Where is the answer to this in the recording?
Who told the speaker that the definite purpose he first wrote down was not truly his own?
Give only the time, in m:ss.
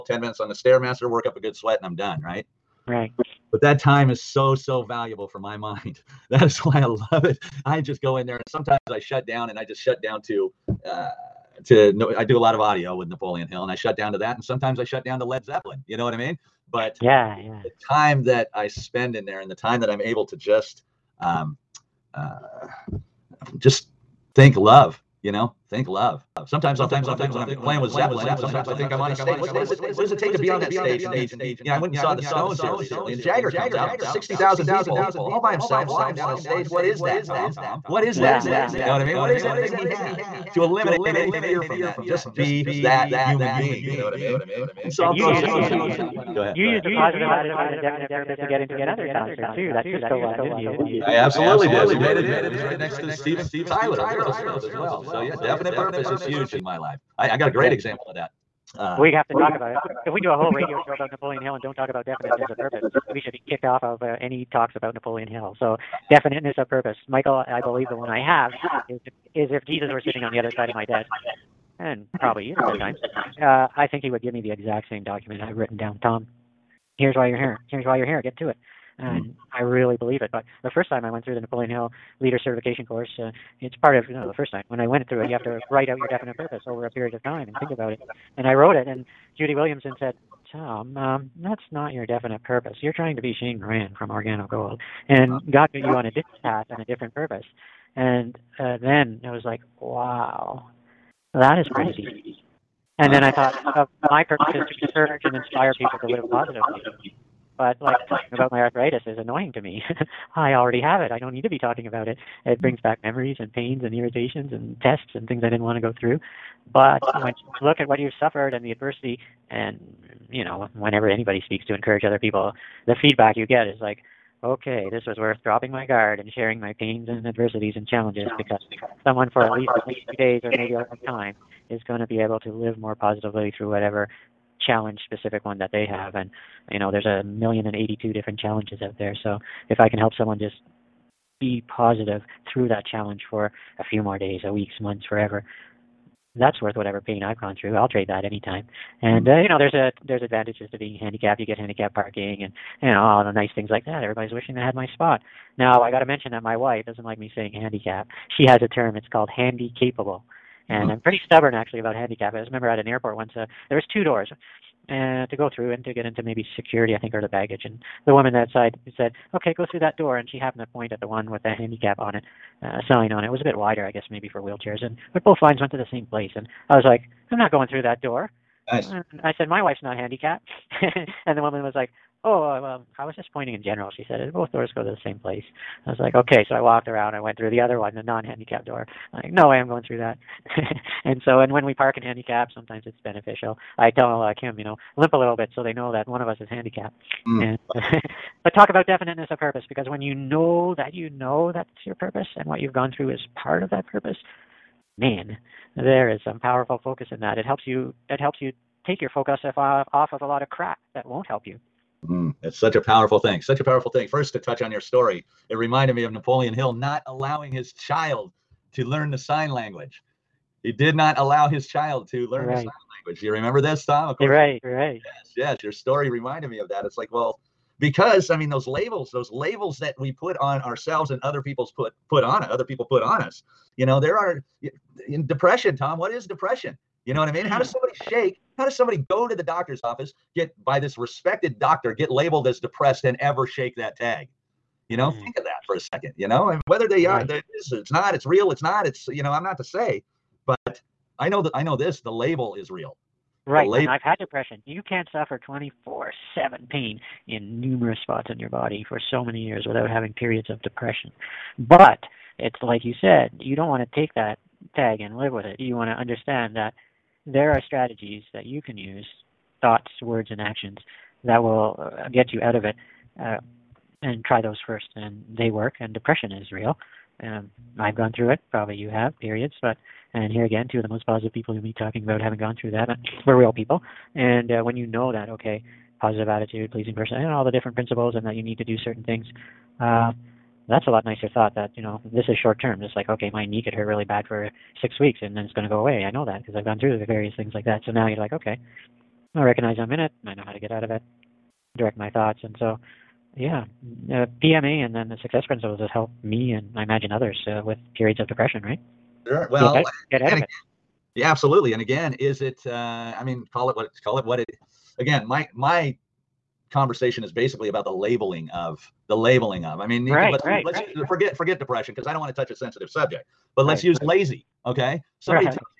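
1:29.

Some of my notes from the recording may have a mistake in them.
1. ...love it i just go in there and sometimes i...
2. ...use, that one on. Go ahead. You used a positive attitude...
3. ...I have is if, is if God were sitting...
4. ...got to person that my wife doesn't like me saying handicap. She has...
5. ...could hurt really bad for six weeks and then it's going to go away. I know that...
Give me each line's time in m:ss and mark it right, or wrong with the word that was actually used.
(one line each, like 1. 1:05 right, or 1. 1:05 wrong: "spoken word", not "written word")
1. 0:06 right
2. 0:45 right
3. 1:08 wrong: "Jesus", not "God"
4. 2:35 wrong: "mention", not "person"
5. 4:53 right.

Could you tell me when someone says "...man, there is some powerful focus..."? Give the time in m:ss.
3:24.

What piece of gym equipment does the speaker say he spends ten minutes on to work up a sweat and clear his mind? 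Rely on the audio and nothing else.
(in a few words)
Stairmaster.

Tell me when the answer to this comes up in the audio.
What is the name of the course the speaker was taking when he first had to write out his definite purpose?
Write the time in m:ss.
1:22.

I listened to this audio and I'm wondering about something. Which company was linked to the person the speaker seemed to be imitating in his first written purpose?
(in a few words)
Organo Gold.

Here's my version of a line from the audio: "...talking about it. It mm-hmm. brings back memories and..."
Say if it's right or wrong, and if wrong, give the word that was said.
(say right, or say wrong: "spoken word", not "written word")
right.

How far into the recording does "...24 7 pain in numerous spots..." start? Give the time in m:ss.
4:15.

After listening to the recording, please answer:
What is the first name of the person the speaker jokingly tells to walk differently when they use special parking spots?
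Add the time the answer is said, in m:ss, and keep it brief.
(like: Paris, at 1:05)
Kim, at 3:14.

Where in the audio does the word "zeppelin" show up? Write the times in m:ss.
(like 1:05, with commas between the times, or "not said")
0:15, 0:27.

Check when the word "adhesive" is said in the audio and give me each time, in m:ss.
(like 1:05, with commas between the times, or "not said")
not said.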